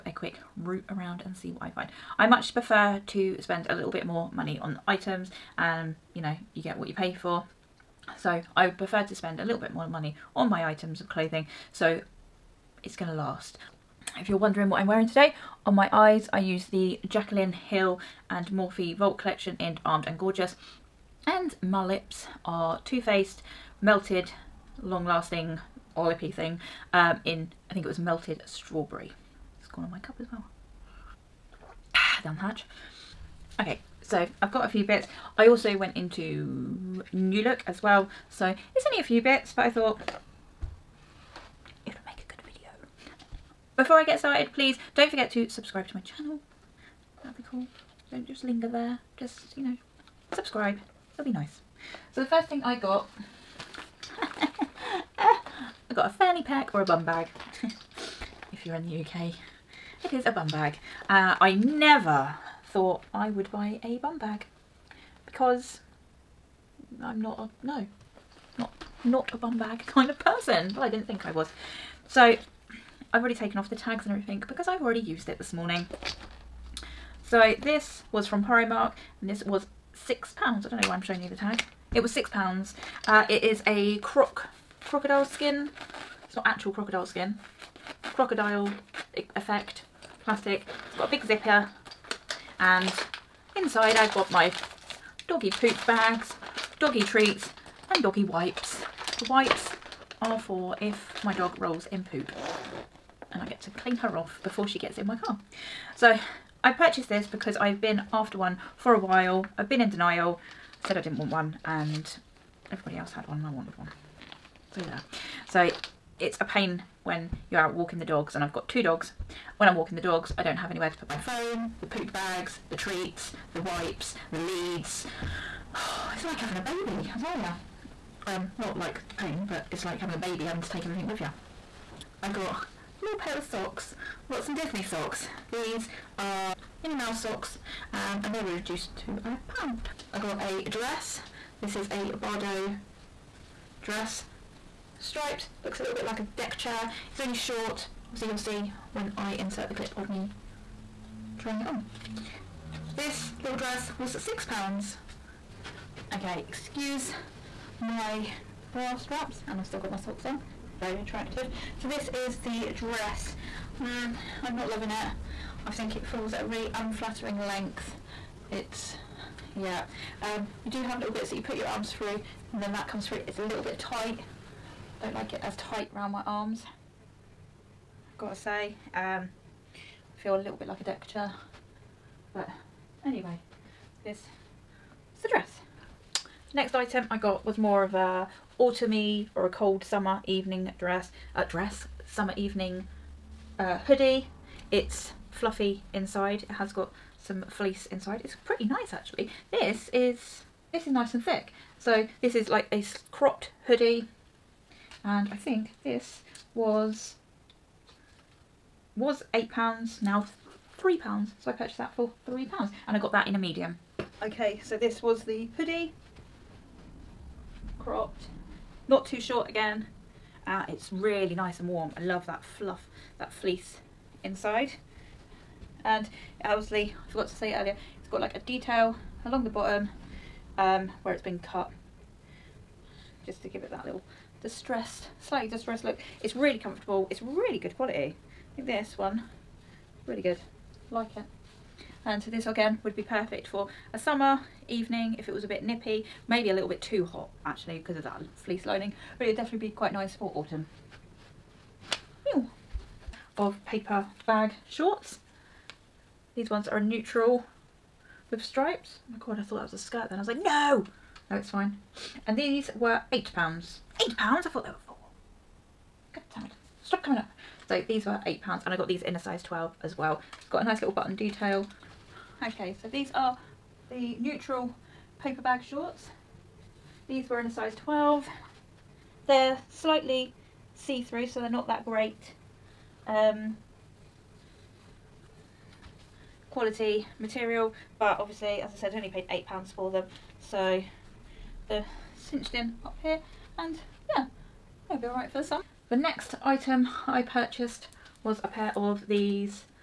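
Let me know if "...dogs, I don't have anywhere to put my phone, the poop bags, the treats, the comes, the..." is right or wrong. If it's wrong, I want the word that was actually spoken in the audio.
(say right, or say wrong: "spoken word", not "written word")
wrong: "wipes", not "comes".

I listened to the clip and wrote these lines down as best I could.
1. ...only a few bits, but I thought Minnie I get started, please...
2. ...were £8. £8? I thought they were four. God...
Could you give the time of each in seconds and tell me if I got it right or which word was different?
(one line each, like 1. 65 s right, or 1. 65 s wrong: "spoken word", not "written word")
1. 38 s wrong: "Before", not "Minnie"
2. 262 s right.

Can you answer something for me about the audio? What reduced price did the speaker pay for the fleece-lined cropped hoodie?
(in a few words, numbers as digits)
3 pounds.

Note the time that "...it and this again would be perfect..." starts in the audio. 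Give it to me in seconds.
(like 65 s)
241 s.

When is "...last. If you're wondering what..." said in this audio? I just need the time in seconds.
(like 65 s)
13 s.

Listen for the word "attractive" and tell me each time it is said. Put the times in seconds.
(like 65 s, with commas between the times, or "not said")
161 s.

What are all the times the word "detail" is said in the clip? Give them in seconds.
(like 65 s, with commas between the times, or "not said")
228 s, 271 s.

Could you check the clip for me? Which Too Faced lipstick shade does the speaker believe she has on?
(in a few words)
Melted Strawberry.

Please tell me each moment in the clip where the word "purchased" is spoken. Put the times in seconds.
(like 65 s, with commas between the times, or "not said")
106 s, 211 s, 297 s.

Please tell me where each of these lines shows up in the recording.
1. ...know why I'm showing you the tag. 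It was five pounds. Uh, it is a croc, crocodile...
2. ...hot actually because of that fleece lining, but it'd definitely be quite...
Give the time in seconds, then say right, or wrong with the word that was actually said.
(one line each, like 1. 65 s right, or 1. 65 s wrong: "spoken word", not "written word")
1. 80 s wrong: "six", not "five"
2. 247 s right.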